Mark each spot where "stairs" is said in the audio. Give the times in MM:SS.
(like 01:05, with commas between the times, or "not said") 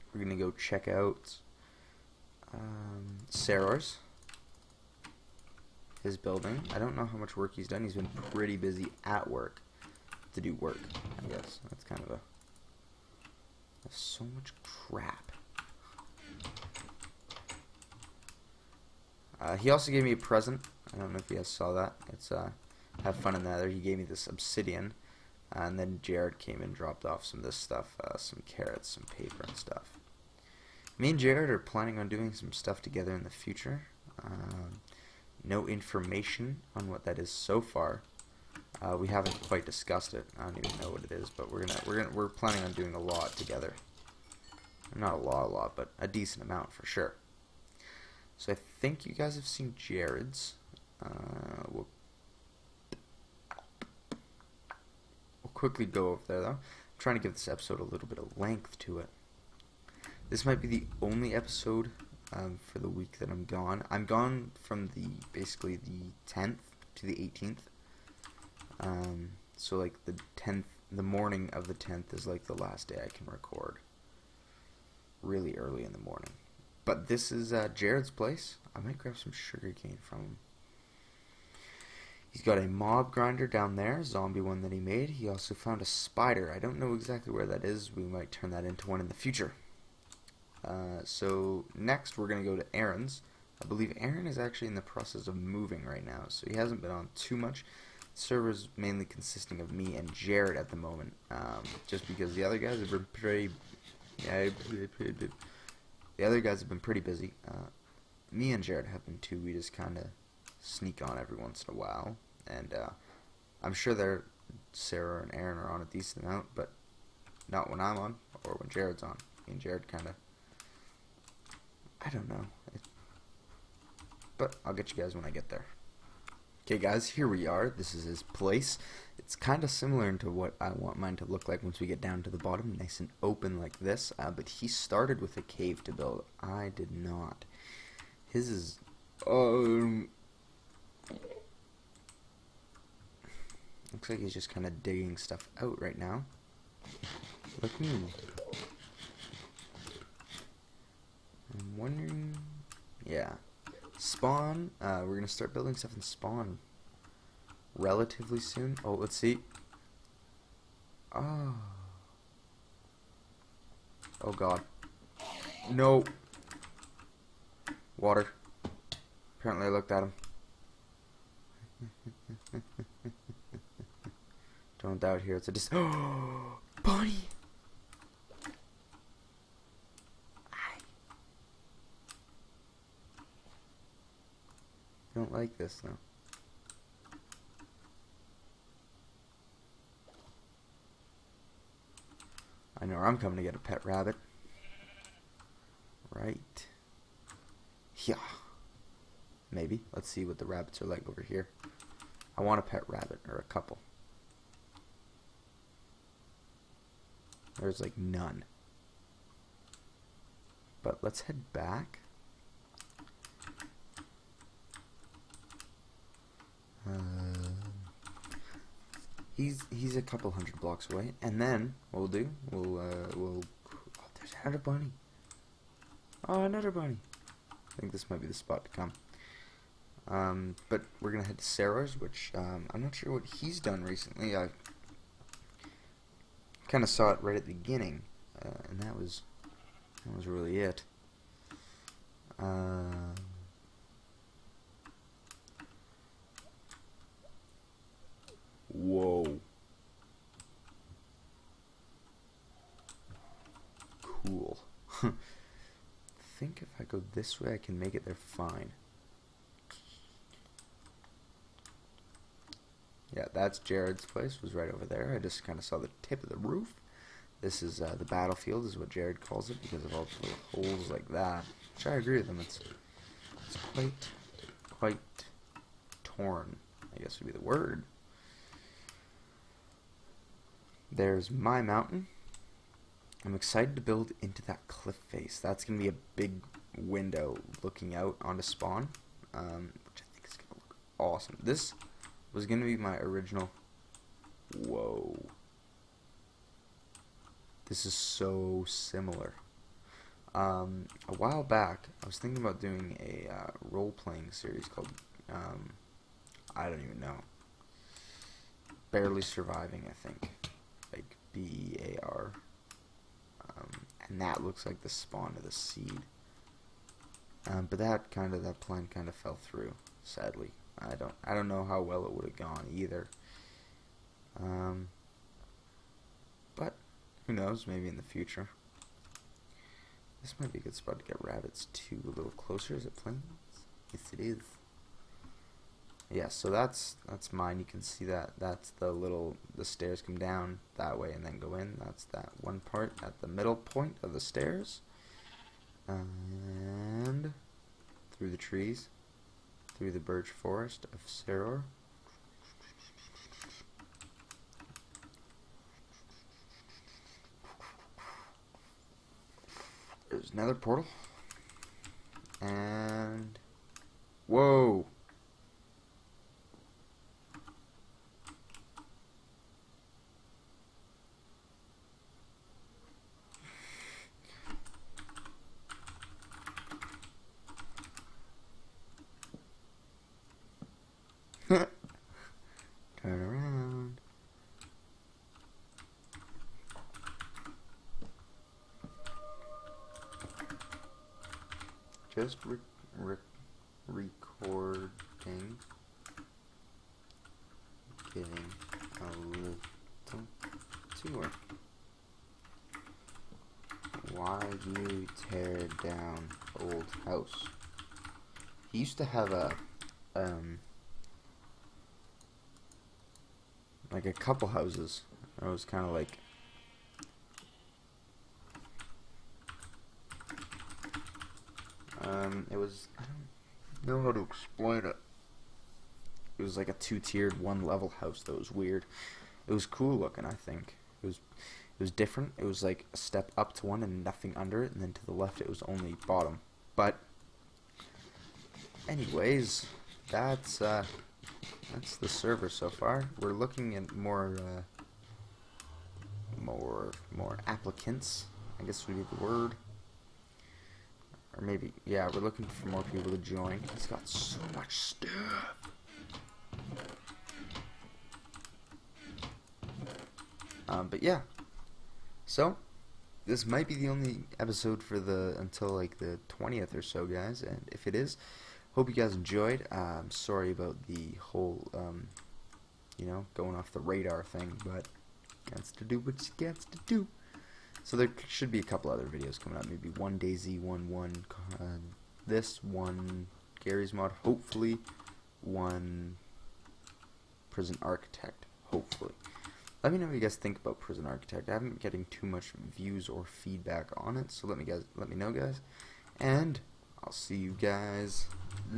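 05:39, 05:44.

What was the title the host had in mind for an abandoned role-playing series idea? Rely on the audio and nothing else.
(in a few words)
Barely Surviving.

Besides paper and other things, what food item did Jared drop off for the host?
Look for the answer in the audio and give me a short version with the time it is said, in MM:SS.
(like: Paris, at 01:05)
Carrots, at 00:28.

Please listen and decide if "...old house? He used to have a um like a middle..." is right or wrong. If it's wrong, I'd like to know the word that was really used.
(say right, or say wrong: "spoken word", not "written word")
wrong: "couple", not "middle".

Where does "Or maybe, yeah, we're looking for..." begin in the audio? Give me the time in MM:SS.
07:31.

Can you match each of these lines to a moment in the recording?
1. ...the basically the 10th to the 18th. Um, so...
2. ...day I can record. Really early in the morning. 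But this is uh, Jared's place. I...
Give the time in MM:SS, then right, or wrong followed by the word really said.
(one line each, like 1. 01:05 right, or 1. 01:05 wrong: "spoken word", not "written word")
1. 01:04 right
2. 01:12 right.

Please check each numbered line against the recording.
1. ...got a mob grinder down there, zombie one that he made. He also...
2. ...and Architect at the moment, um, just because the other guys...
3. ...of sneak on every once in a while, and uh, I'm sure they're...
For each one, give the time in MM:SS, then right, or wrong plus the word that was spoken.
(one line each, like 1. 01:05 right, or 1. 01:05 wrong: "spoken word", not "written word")
1. 01:22 right
2. 01:39 wrong: "Jared", not "Architect"
3. 01:49 right.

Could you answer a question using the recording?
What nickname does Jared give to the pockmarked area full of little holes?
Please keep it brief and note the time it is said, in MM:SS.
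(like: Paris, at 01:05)
The battlefield, at 04:27.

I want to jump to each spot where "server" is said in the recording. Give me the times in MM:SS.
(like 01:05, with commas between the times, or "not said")
01:38, 07:22.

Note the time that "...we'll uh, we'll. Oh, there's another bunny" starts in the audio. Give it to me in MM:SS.
03:42.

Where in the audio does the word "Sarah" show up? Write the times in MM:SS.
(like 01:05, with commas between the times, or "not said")
01:54, 03:51.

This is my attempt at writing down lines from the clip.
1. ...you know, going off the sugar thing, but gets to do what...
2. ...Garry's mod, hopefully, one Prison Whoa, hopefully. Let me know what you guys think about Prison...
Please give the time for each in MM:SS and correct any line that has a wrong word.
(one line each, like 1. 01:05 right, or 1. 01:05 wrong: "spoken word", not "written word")
1. 07:52 wrong: "radar", not "sugar"
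2. 08:03 wrong: "Architect", not "Whoa".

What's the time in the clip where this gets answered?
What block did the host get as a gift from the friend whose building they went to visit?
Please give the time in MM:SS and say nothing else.
00:24.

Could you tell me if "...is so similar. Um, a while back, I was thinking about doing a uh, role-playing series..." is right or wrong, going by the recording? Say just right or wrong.
right.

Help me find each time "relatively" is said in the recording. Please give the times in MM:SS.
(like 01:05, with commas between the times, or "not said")
02:37.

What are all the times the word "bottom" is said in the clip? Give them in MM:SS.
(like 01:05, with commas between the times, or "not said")
02:12, 07:16.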